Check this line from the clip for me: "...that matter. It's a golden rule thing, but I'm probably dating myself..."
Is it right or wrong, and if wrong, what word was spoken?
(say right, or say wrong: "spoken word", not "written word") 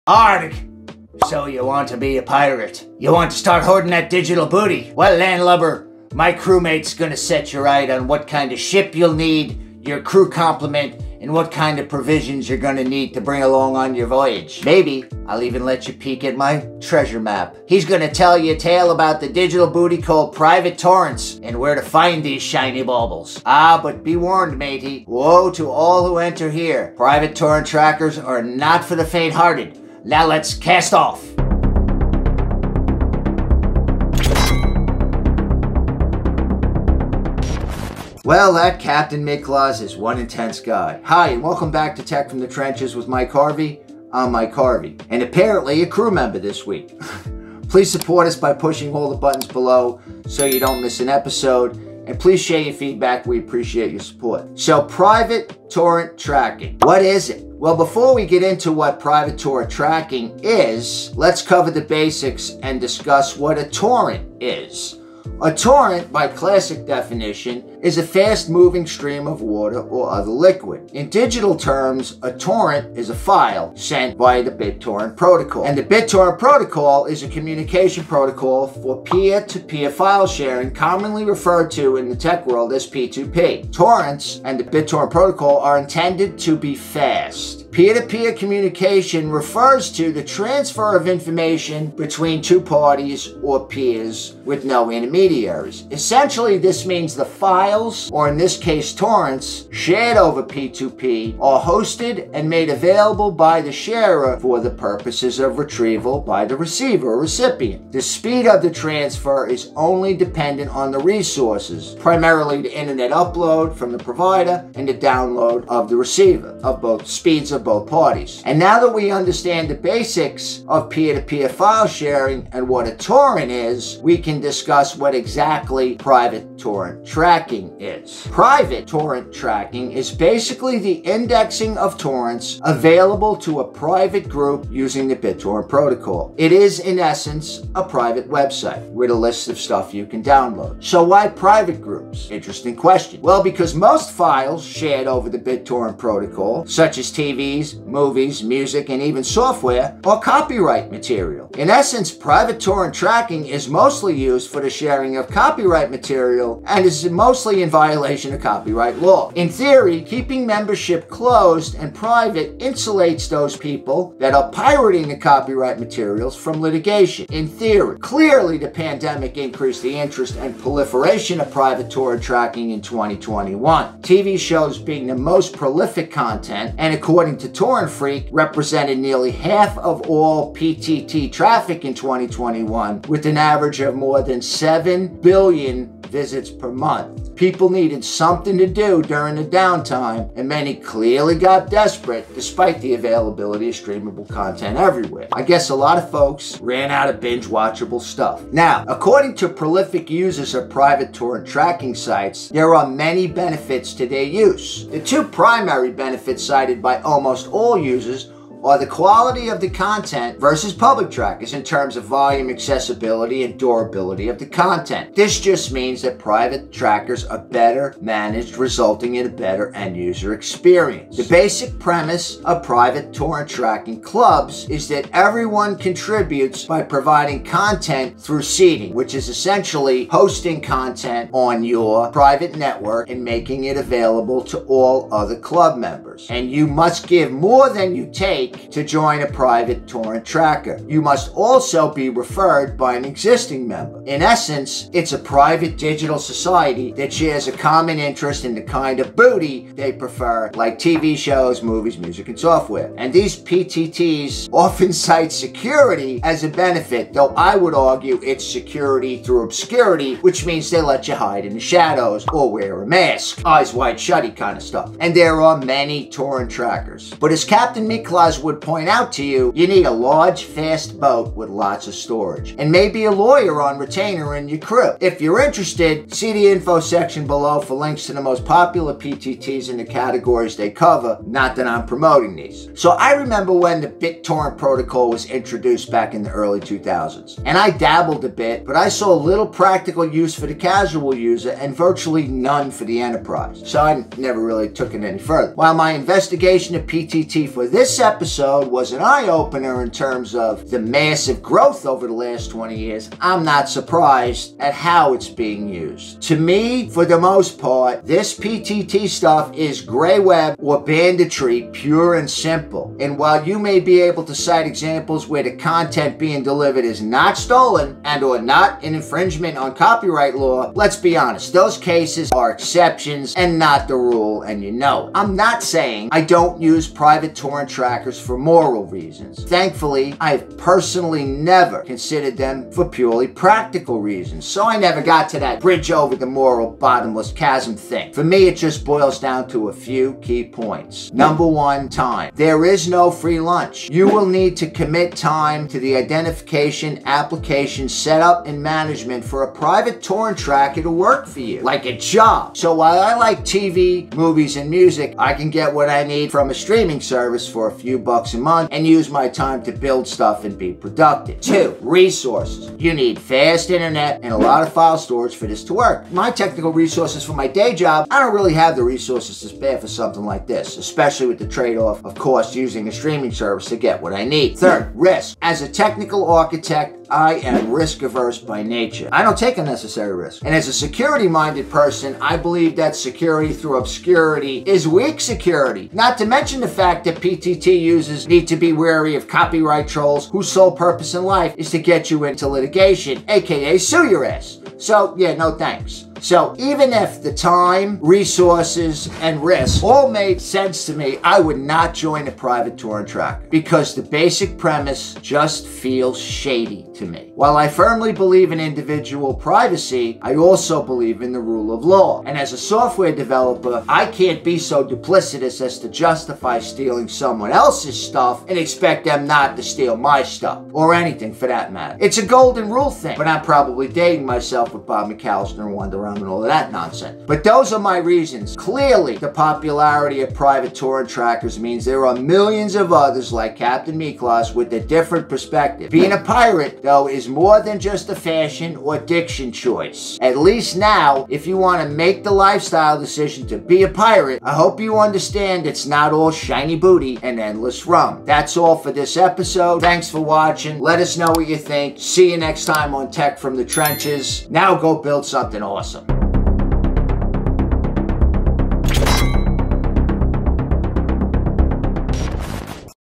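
right.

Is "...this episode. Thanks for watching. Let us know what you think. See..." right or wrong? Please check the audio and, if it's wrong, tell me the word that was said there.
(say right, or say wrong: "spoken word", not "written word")
right.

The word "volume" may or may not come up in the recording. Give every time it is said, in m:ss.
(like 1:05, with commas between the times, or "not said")
3:32.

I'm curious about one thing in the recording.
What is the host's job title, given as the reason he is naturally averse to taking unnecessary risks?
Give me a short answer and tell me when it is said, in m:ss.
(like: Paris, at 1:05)
technical architect, at 6:15.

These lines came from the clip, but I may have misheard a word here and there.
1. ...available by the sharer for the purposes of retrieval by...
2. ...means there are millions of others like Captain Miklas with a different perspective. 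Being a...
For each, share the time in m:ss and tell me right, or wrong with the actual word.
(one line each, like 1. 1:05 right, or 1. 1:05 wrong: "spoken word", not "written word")
1. 1:42 right
2. 7:11 right.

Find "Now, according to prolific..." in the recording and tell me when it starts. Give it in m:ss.
3:18.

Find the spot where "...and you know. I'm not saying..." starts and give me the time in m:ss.
5:24.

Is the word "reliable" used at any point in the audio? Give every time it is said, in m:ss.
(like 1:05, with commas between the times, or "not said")
not said.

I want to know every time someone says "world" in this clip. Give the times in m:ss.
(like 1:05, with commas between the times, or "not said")
1:22.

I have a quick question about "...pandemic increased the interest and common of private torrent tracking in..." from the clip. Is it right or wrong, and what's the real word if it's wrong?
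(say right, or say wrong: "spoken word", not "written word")
wrong: "proliferation", not "common".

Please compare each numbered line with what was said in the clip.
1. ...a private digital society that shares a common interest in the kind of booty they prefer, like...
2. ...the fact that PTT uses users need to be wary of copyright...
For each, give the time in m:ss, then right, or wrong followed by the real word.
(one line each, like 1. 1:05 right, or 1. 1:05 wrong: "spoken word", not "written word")
1. 4:05 right
2. 6:26 right.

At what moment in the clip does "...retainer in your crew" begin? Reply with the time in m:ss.
4:33.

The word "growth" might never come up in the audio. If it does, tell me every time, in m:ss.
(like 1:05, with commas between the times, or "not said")
5:01.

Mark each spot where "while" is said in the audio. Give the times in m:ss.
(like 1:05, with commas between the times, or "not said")
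4:55, 5:13, 5:52, 6:47.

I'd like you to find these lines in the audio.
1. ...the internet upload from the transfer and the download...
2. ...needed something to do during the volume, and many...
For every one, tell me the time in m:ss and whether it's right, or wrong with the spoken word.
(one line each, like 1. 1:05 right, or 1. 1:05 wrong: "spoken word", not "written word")
1. 1:52 wrong: "provider", not "transfer"
2. 3:07 wrong: "downtime", not "volume".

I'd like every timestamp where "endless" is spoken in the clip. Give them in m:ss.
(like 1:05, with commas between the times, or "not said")
7:27.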